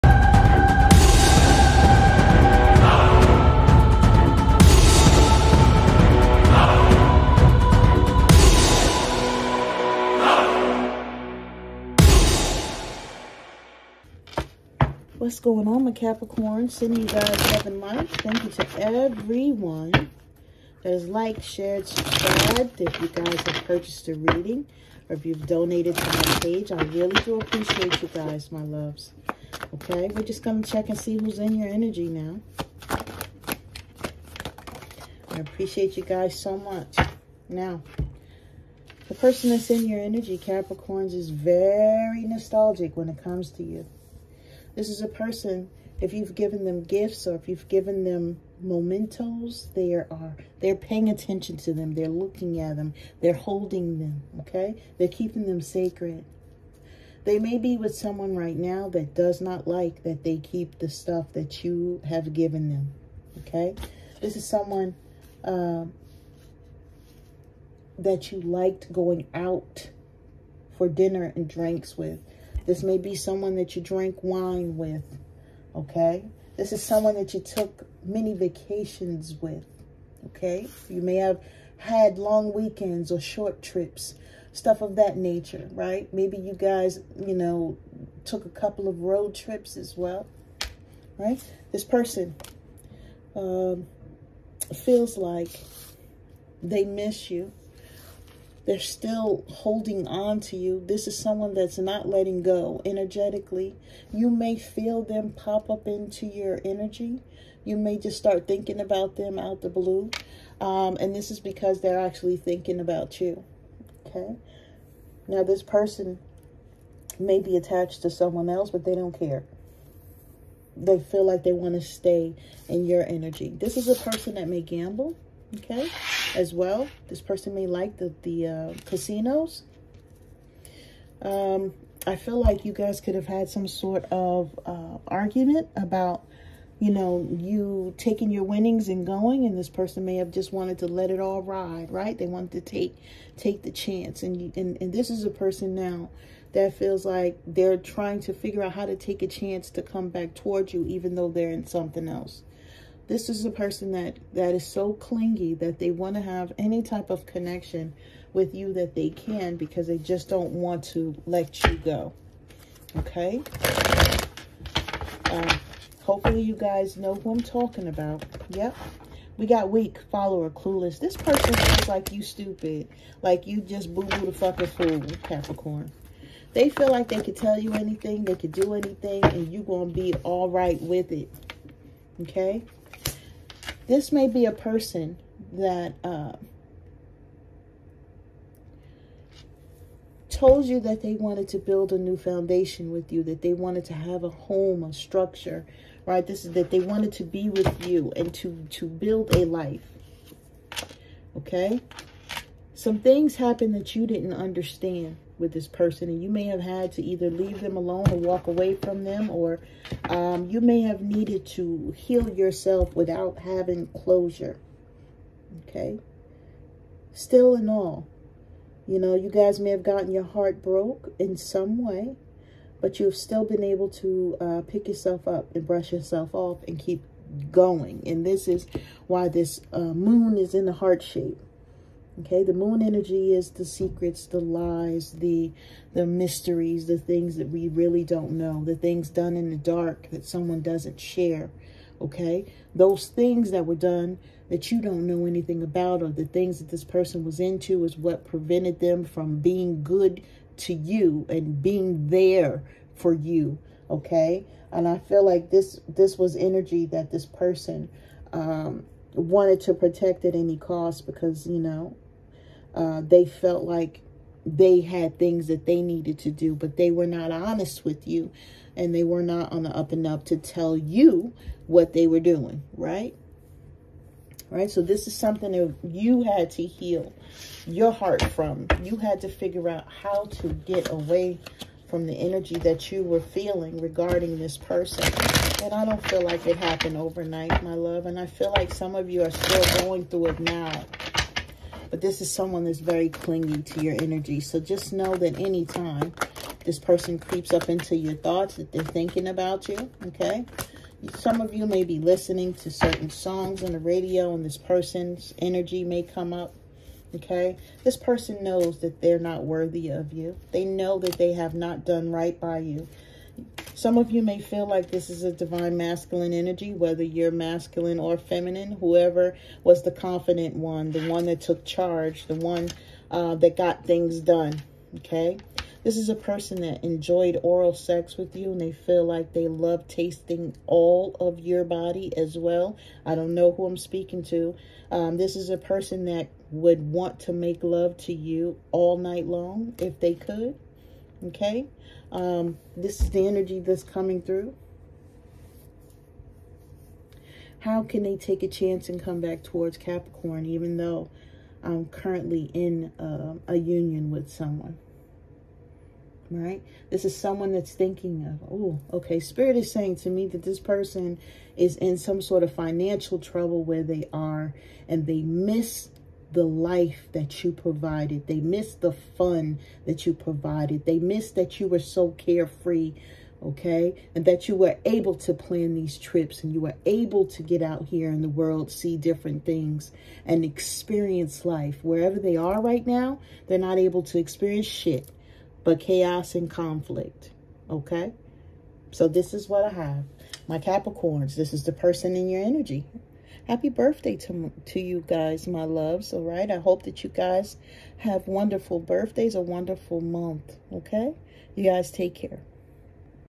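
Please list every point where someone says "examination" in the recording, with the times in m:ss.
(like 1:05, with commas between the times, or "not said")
not said.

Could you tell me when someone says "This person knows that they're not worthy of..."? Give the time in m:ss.
5:07.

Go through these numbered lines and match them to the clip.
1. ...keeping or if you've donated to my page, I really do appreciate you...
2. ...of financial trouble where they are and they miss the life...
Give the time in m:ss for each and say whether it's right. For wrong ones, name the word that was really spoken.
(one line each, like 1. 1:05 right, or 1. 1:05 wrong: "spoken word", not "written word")
1. 0:24 wrong: "reading", not "keeping"
2. 6:02 right.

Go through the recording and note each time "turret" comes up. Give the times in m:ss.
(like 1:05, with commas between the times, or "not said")
not said.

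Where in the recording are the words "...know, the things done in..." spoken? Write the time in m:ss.
3:58.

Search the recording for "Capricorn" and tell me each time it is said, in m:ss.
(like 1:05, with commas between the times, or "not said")
0:15, 0:40, 2:55, 5:49, 6:30.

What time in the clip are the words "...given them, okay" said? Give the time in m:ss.
1:02.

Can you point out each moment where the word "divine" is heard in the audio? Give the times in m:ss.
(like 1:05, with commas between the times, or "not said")
5:15.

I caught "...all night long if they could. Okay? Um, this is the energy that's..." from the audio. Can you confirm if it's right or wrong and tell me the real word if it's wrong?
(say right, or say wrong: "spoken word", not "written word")
right.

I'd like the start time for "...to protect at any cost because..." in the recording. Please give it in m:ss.
4:19.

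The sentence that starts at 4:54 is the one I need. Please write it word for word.
So just know that anytime this person creeps up into your thoughts, that they're thinking about you, okay?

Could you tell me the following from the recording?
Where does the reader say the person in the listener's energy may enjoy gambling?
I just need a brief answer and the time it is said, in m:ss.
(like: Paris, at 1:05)
Casinos, at 2:08.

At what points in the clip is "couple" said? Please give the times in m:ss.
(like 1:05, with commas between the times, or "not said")
1:28.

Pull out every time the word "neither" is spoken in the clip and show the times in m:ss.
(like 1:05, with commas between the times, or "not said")
not said.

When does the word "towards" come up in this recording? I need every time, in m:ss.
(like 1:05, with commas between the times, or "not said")
2:30, 5:49.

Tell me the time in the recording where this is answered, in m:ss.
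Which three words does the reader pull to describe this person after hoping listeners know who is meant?
2:49.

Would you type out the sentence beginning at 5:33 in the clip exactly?
I don't know who I'm speaking to.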